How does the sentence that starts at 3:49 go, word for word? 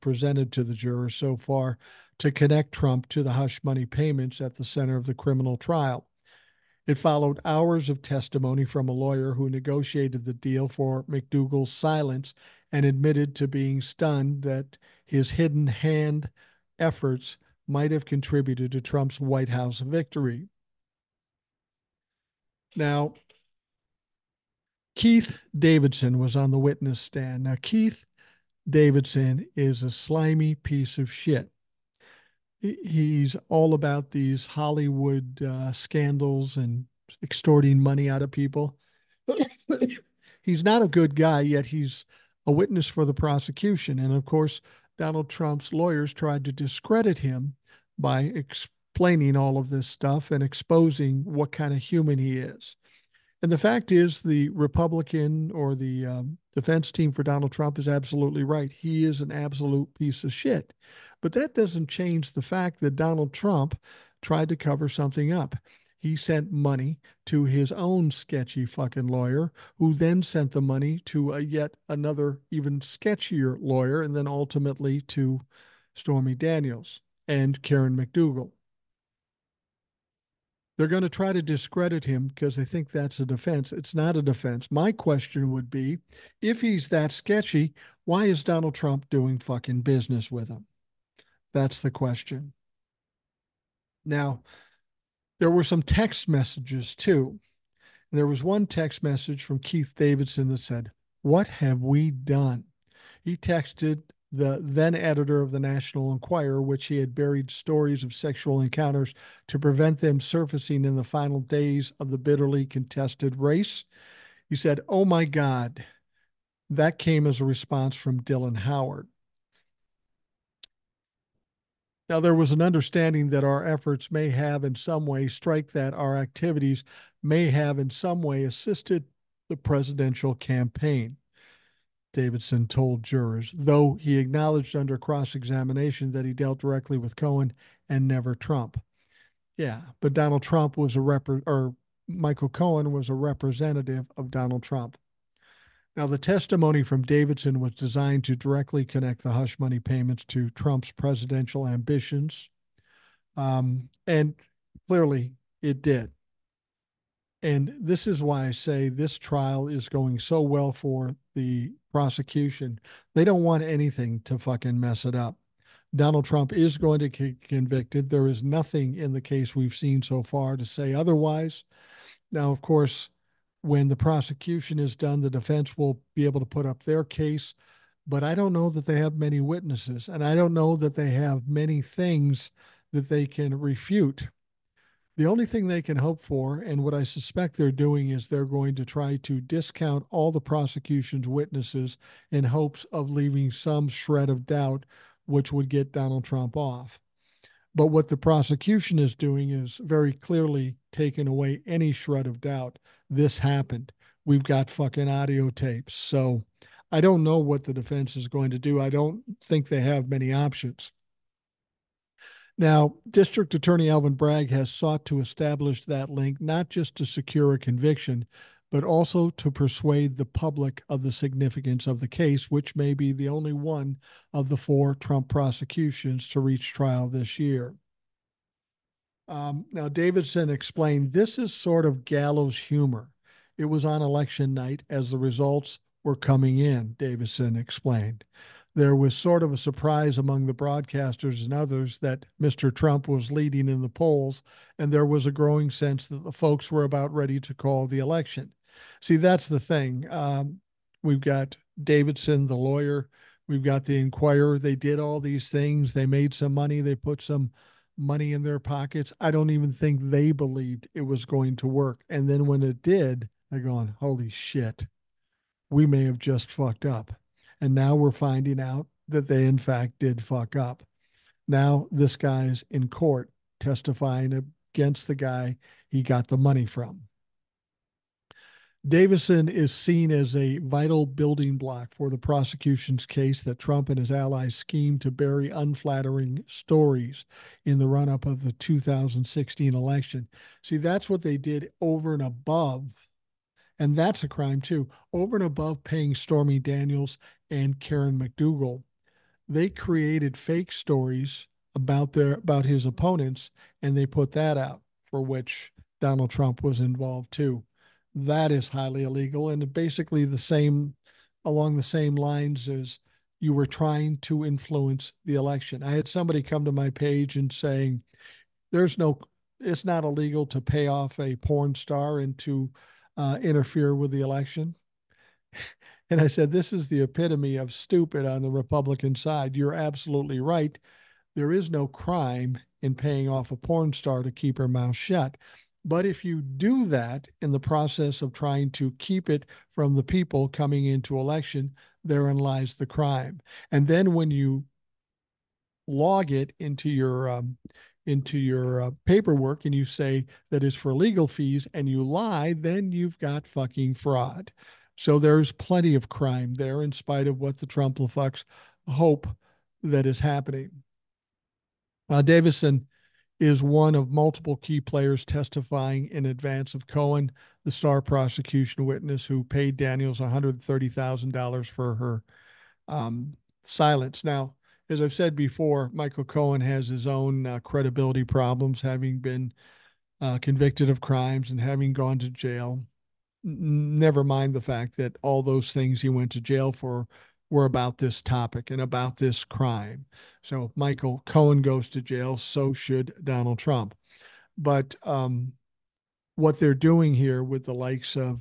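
Um, now, Davidson explained this is sort of gallows humor.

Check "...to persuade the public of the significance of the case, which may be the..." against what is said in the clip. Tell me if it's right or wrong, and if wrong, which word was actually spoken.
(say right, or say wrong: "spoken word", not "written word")
right.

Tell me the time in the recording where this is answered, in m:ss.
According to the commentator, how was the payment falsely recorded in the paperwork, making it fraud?
5:50.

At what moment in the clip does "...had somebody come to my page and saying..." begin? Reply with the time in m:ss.
5:15.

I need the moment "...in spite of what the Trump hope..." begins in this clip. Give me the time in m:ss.
5:56.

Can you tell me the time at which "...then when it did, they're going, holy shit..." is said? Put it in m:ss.
4:22.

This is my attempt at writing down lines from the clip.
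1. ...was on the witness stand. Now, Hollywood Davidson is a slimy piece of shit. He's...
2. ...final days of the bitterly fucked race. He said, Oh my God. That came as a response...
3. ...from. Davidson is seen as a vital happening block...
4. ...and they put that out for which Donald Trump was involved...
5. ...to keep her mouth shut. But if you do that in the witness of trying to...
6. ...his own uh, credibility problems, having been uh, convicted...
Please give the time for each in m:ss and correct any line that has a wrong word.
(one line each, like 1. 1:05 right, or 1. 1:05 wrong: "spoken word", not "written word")
1. 0:26 wrong: "Keith", not "Hollywood"
2. 1:51 wrong: "contested", not "fucked"
3. 4:36 wrong: "building", not "happening"
4. 5:03 right
5. 5:34 wrong: "process", not "witness"
6. 6:16 right.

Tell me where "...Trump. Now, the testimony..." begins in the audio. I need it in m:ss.
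2:24.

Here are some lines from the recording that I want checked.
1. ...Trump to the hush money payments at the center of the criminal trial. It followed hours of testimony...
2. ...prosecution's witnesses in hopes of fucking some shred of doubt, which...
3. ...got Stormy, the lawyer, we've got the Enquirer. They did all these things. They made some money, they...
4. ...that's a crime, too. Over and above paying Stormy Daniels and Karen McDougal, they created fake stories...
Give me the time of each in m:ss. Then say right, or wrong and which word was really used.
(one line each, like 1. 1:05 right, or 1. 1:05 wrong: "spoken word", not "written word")
1. 0:02 right
2. 3:10 wrong: "leaving", not "fucking"
3. 4:11 wrong: "Davidson", not "Stormy"
4. 4:53 right.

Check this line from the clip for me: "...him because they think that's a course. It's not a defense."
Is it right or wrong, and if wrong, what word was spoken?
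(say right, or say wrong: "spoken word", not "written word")
wrong: "defense", not "course".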